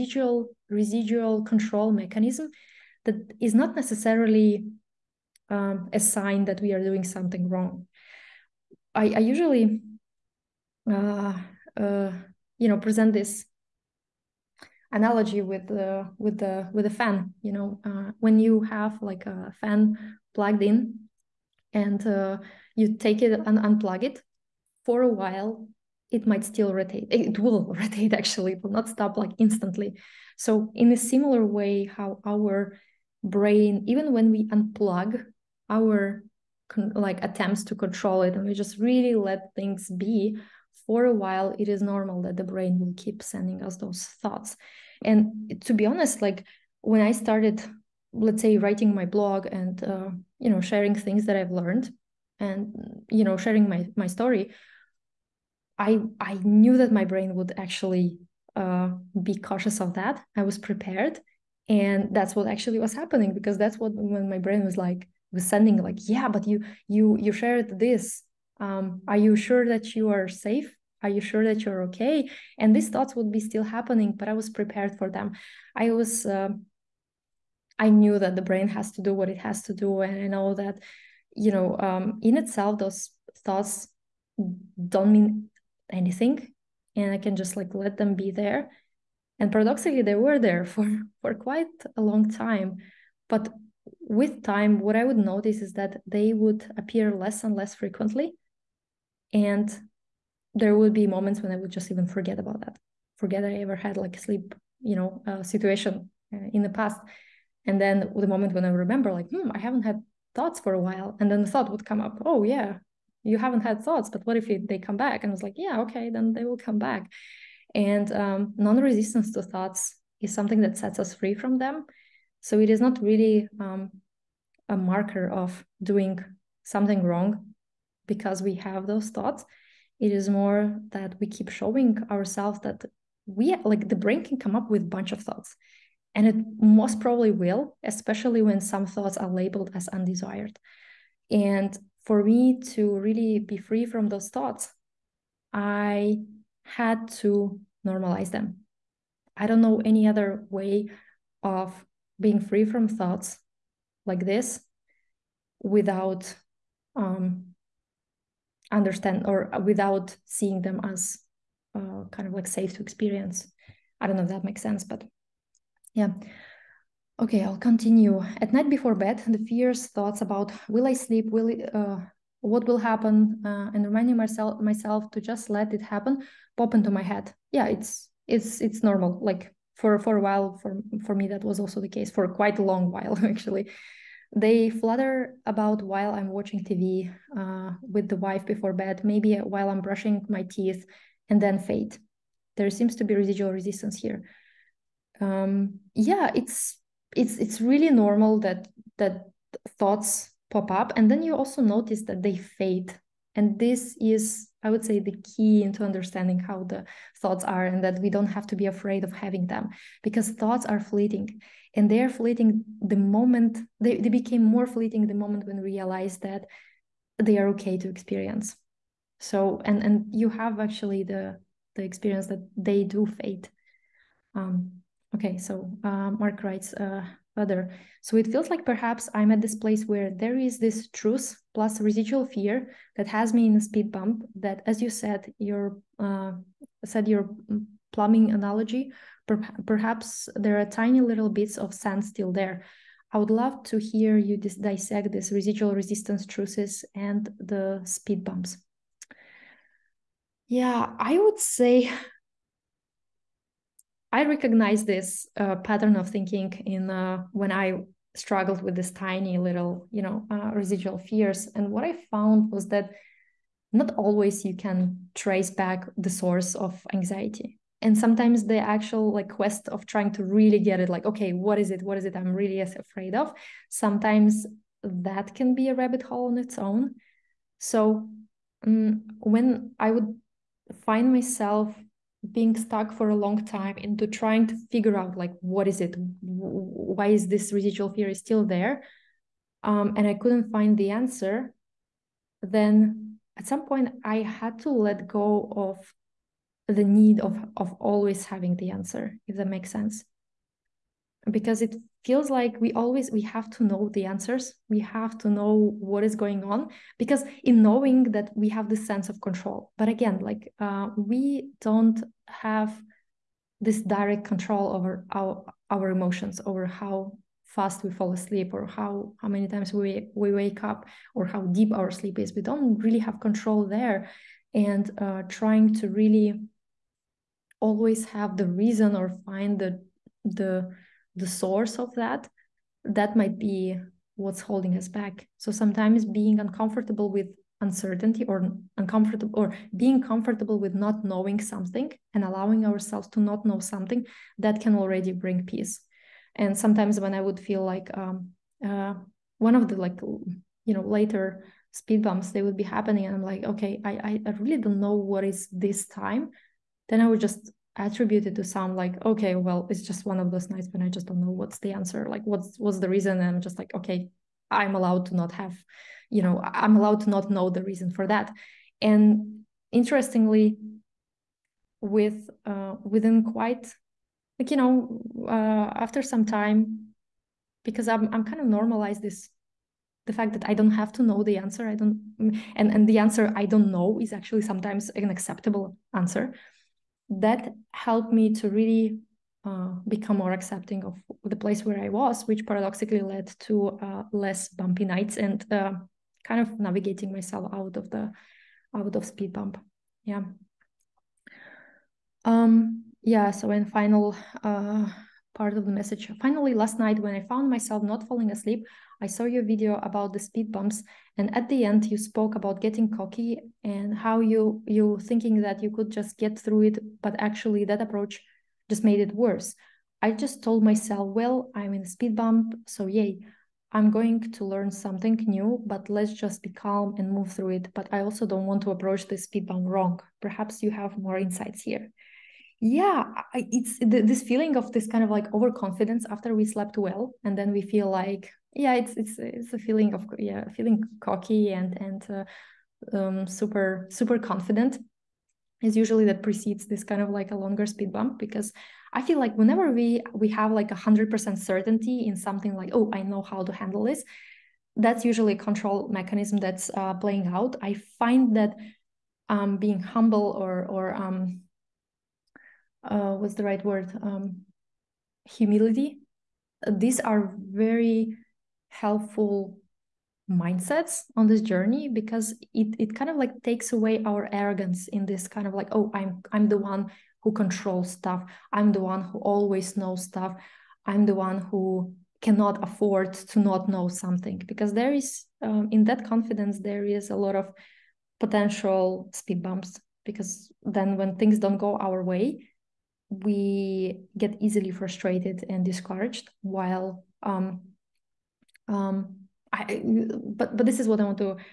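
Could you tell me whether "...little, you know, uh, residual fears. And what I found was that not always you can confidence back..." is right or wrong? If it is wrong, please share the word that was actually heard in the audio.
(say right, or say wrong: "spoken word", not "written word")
wrong: "trace", not "confidence".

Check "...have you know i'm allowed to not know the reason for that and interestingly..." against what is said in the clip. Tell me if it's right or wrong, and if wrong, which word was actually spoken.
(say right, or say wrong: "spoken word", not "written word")
right.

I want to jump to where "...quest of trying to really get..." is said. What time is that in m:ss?
4:29.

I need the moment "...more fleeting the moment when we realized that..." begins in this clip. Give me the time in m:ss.
3:34.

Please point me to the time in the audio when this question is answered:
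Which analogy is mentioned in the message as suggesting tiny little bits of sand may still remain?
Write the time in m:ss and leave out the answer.
3:57.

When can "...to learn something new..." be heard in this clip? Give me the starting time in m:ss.
7:04.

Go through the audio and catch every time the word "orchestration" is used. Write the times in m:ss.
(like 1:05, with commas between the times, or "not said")
not said.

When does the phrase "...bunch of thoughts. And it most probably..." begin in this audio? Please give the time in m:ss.
2:14.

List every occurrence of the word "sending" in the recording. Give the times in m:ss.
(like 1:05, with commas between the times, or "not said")
0:43, 1:05.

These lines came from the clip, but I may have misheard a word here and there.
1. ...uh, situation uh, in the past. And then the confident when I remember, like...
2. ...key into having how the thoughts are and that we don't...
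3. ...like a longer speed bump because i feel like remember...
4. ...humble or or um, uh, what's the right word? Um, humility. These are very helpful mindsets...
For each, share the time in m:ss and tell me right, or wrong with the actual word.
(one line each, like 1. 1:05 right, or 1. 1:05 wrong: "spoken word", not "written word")
1. 1:45 wrong: "moment", not "confident"
2. 3:25 wrong: "understanding", not "having"
3. 7:27 wrong: "whenever", not "remember"
4. 7:39 right.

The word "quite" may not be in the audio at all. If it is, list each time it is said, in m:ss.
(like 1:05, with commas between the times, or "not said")
1:31, 3:02, 6:13.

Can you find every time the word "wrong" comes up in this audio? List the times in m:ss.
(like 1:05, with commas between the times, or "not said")
0:07, 2:07, 7:09.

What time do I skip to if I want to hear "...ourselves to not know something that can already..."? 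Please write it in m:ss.
5:42.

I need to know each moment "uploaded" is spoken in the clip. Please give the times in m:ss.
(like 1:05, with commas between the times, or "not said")
not said.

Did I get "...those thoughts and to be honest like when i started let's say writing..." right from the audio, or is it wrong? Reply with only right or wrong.
right.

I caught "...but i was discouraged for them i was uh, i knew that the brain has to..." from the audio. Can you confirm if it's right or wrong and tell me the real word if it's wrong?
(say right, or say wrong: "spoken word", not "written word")
wrong: "prepared", not "discouraged".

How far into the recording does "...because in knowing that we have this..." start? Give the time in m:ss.
5:06.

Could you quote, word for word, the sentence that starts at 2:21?
And for me to really be free from those thoughts, I had to normalize them.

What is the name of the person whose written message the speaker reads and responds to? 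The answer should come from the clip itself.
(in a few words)
Mark.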